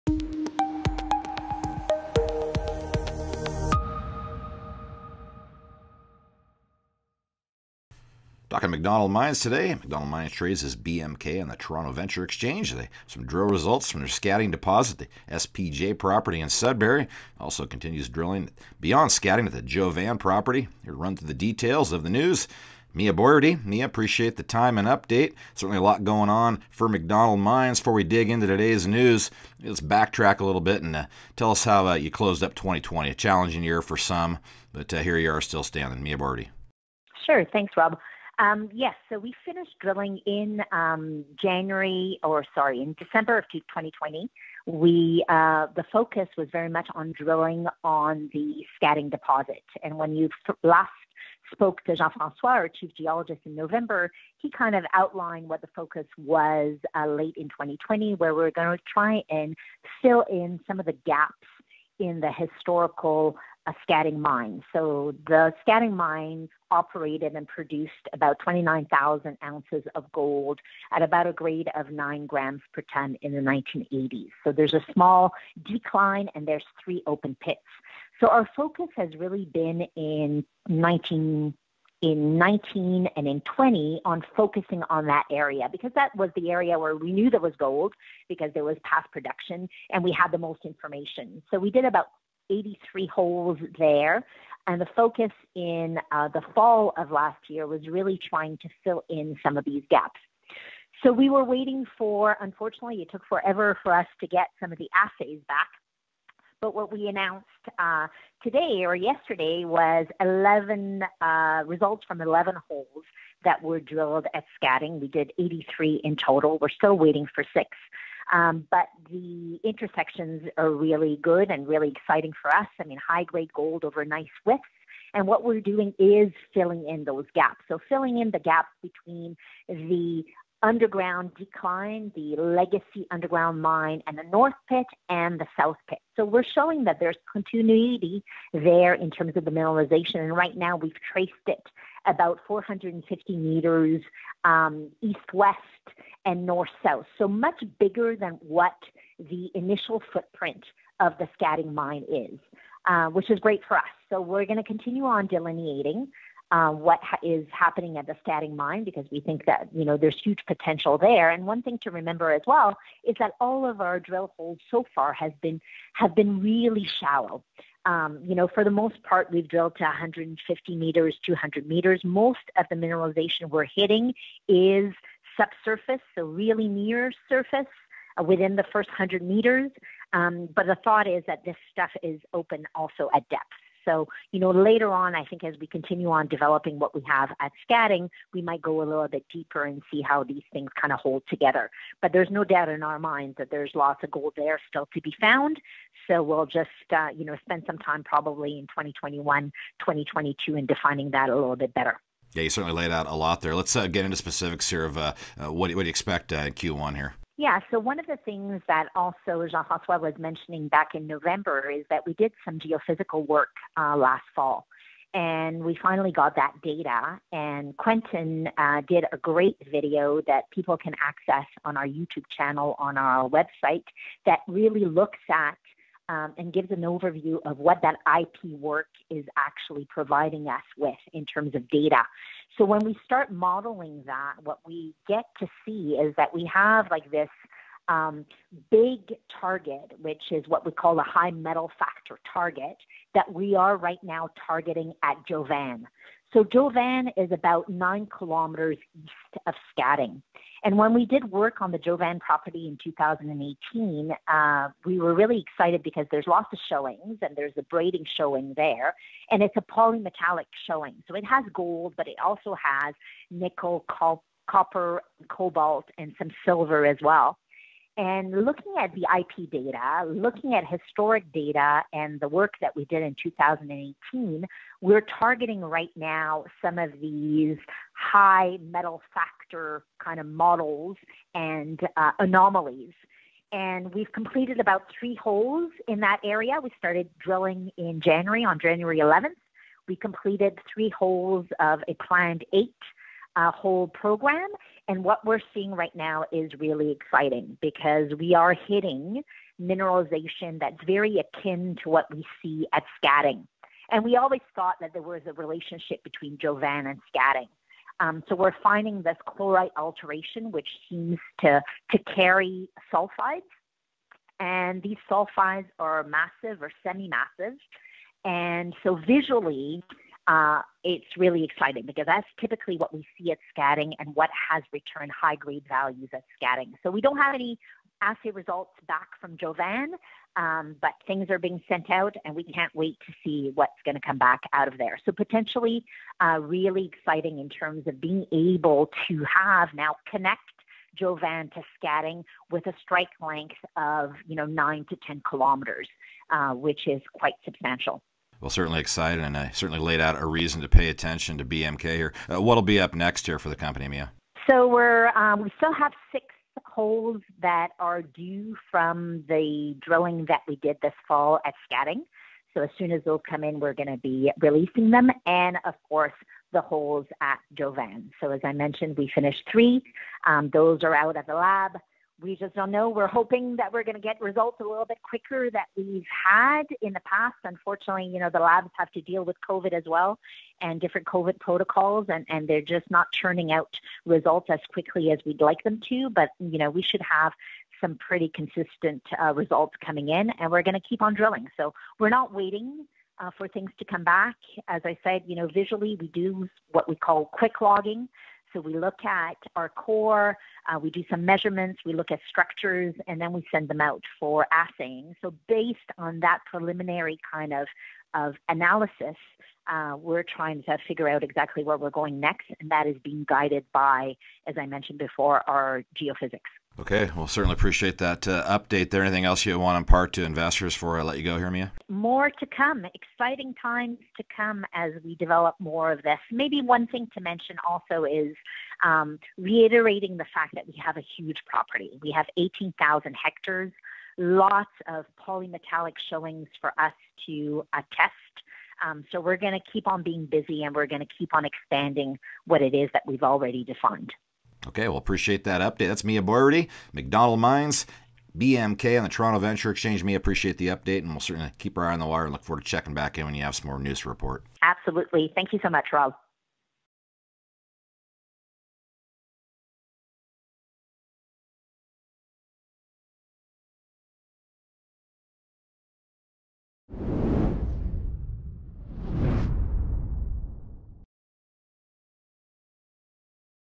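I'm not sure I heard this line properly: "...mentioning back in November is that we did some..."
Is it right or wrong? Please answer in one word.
right.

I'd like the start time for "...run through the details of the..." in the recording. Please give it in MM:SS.
00:20.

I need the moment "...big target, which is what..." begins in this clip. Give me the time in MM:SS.
03:58.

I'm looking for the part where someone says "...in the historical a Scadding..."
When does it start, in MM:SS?
01:01.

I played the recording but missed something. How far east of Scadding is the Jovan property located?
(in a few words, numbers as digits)
9 kilometers.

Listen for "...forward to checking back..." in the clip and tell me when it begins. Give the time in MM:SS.
07:32.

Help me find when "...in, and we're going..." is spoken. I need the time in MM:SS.
06:30.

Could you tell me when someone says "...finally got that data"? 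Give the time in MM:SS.
03:35.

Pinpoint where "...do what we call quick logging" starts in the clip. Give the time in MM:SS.
06:36.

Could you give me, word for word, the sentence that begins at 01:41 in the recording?
So we were waiting for, unfortunately, it took forever for us to get some of the assays back.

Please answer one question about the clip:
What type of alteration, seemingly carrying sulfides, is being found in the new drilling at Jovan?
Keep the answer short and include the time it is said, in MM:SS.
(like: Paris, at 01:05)
chlorite alteration, at 05:09.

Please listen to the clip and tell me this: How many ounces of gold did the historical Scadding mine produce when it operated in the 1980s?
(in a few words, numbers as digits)
29,000.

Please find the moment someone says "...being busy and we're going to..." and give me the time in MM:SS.
07:20.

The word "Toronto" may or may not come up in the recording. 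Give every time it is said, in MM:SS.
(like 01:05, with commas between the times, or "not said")
00:11, 07:29.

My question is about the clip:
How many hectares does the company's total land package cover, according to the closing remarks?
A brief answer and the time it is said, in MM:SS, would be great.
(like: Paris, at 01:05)
18,000, at 07:12.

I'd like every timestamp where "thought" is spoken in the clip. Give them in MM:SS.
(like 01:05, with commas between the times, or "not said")
03:00, 05:04.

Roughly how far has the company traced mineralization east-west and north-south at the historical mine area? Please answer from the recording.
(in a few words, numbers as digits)
450 meters.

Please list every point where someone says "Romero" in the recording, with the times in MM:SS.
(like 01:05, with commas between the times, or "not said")
not said.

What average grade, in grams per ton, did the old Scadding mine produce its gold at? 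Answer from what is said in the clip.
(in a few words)
9 grams per ton.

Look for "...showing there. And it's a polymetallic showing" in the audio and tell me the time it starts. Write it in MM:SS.
04:18.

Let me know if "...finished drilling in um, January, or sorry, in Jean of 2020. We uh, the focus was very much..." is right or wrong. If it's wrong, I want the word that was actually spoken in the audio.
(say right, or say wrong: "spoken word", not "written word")
wrong: "December", not "Jean".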